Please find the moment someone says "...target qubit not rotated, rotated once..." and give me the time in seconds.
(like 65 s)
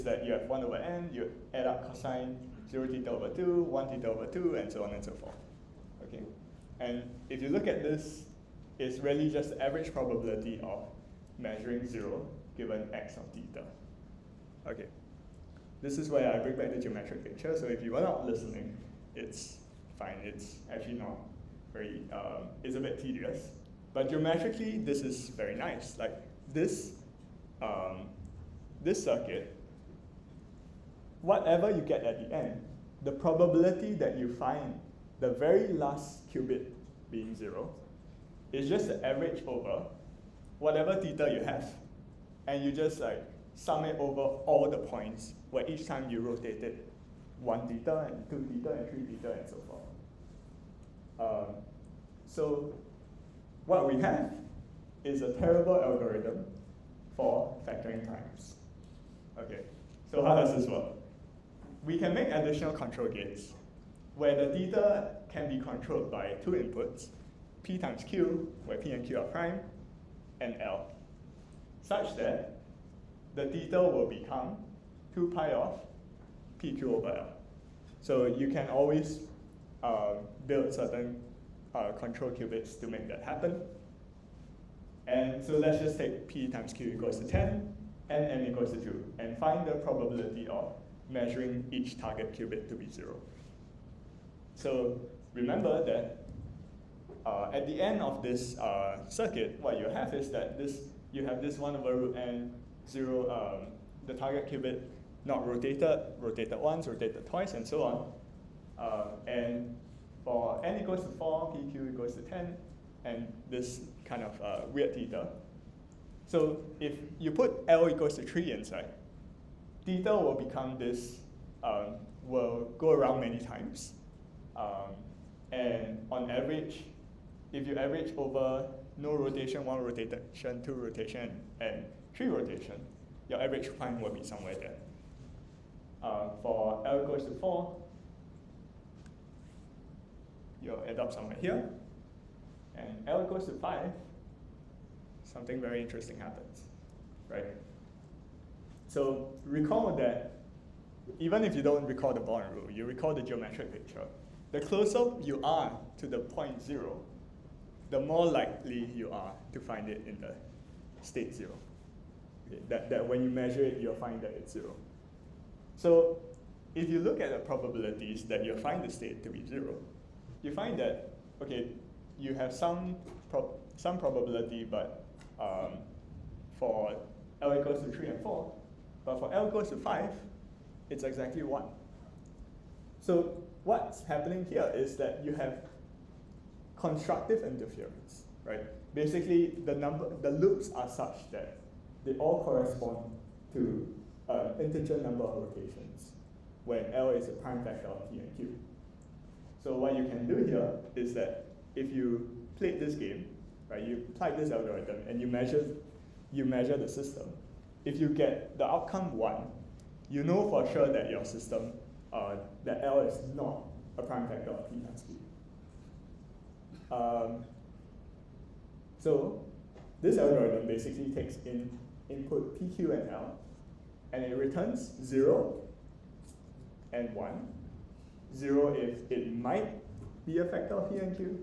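104 s.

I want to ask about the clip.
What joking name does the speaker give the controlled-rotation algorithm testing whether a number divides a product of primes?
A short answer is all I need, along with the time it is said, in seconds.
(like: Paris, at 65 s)
A terrible algorithm for factoring, at 55 s.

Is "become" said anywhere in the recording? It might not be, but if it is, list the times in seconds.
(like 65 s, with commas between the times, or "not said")
74 s, 120 s.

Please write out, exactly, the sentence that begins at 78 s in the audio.
So you can always uh, build certain uh, control qubits to make that happen.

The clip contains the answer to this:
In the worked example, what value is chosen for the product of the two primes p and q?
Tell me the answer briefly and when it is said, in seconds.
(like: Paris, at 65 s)
10, at 111 s.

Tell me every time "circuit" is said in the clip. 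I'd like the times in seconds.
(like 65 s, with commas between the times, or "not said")
29 s, 99 s.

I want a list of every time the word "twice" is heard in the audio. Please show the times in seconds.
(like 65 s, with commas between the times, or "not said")
107 s.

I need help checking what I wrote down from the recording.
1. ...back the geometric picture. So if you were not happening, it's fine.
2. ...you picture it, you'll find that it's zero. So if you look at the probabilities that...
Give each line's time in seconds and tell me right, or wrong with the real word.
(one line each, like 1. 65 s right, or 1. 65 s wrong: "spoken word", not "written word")
1. 16 s wrong: "listening", not "happening"
2. 163 s wrong: "measure", not "picture".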